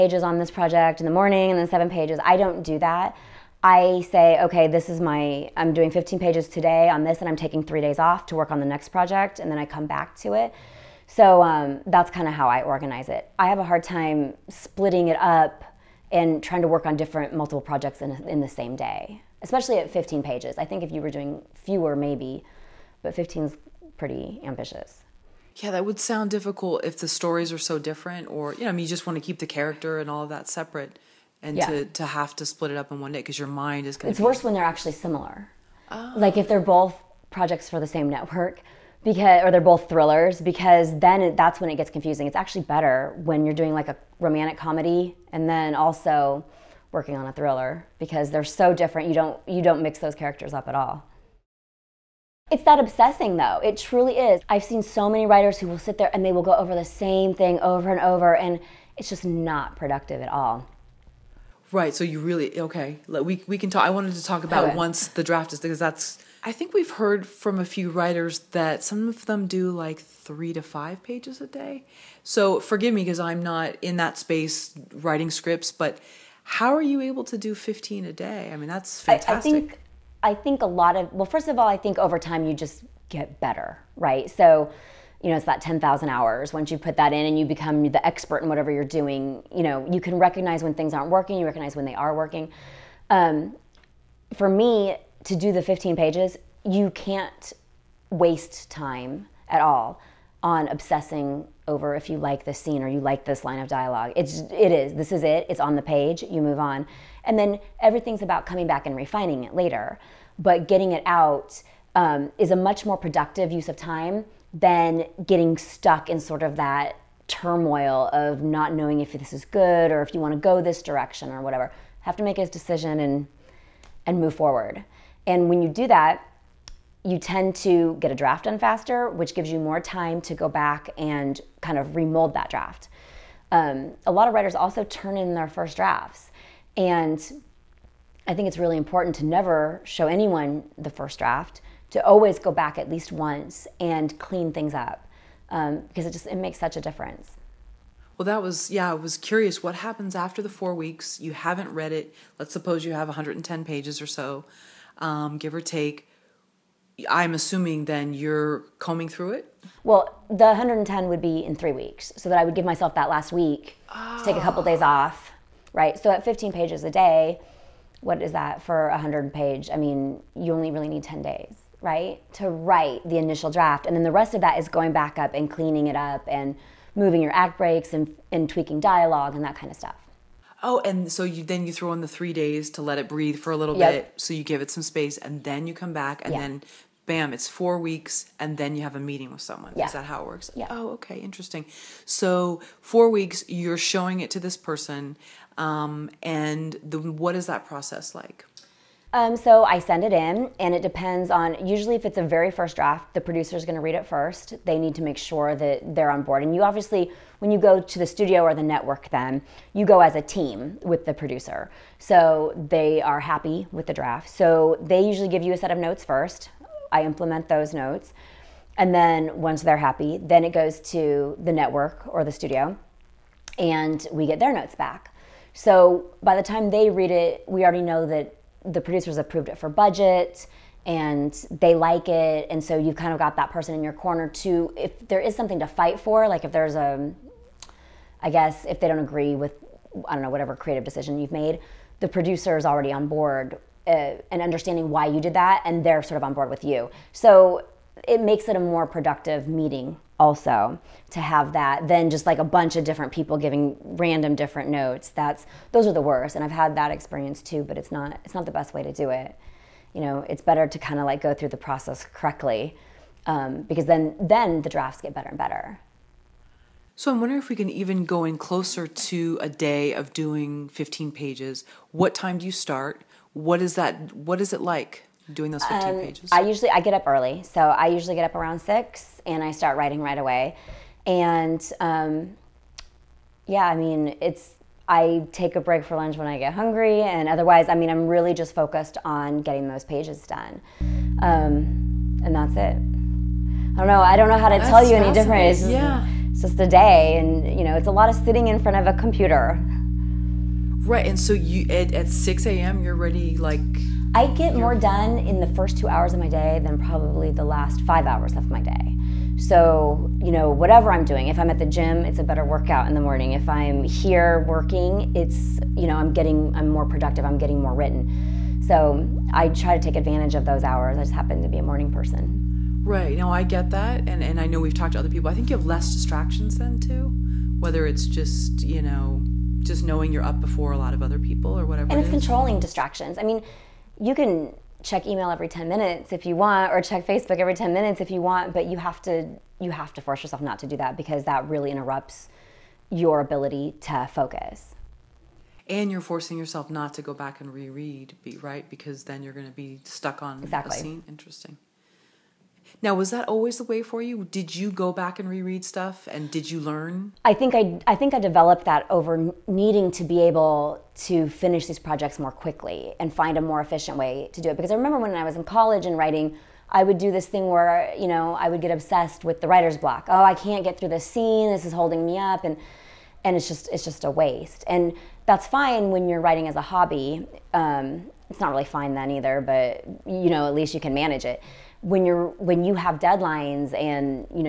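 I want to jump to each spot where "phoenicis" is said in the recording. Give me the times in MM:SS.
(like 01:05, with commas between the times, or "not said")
not said.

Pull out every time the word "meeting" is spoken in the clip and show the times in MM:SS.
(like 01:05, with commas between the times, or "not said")
03:08, 04:09.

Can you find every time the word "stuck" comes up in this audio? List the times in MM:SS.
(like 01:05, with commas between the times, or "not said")
01:55, 05:49.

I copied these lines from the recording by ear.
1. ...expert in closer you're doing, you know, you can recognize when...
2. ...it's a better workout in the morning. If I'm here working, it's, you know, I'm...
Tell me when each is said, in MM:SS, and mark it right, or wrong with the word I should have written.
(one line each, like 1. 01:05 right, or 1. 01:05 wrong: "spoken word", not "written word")
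1. 01:28 wrong: "whatever", not "closer"
2. 05:11 right.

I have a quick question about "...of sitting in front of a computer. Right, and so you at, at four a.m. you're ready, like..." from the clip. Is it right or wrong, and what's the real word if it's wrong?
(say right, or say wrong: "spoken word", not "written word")
wrong: "six", not "four".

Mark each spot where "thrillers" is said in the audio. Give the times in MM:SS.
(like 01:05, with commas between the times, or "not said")
00:39, 00:47.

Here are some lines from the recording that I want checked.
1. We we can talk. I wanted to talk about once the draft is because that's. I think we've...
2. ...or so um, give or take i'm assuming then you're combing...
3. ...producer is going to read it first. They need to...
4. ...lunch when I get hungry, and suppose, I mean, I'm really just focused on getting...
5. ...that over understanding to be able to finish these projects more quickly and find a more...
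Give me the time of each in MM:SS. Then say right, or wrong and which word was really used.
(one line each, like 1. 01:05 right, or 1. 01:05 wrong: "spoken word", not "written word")
1. 01:03 right
2. 02:34 right
3. 03:23 right
4. 04:45 wrong: "otherwise", not "suppose"
5. 05:58 wrong: "needing", not "understanding".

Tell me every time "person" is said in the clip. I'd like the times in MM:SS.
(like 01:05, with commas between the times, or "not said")
03:14, 03:53, 05:21.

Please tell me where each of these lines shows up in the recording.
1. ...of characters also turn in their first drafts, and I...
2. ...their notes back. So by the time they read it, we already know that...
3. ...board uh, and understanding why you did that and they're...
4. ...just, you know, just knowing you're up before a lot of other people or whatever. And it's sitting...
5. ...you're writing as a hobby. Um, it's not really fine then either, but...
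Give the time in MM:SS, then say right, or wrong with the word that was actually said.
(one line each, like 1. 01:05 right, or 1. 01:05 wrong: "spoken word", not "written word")
1. 02:14 wrong: "writers", not "characters"
2. 03:44 right
3. 04:03 right
4. 05:28 wrong: "controlling", not "sitting"
5. 06:16 right.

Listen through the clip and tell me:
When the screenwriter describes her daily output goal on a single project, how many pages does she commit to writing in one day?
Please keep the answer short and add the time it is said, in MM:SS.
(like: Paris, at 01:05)
15, at 00:05.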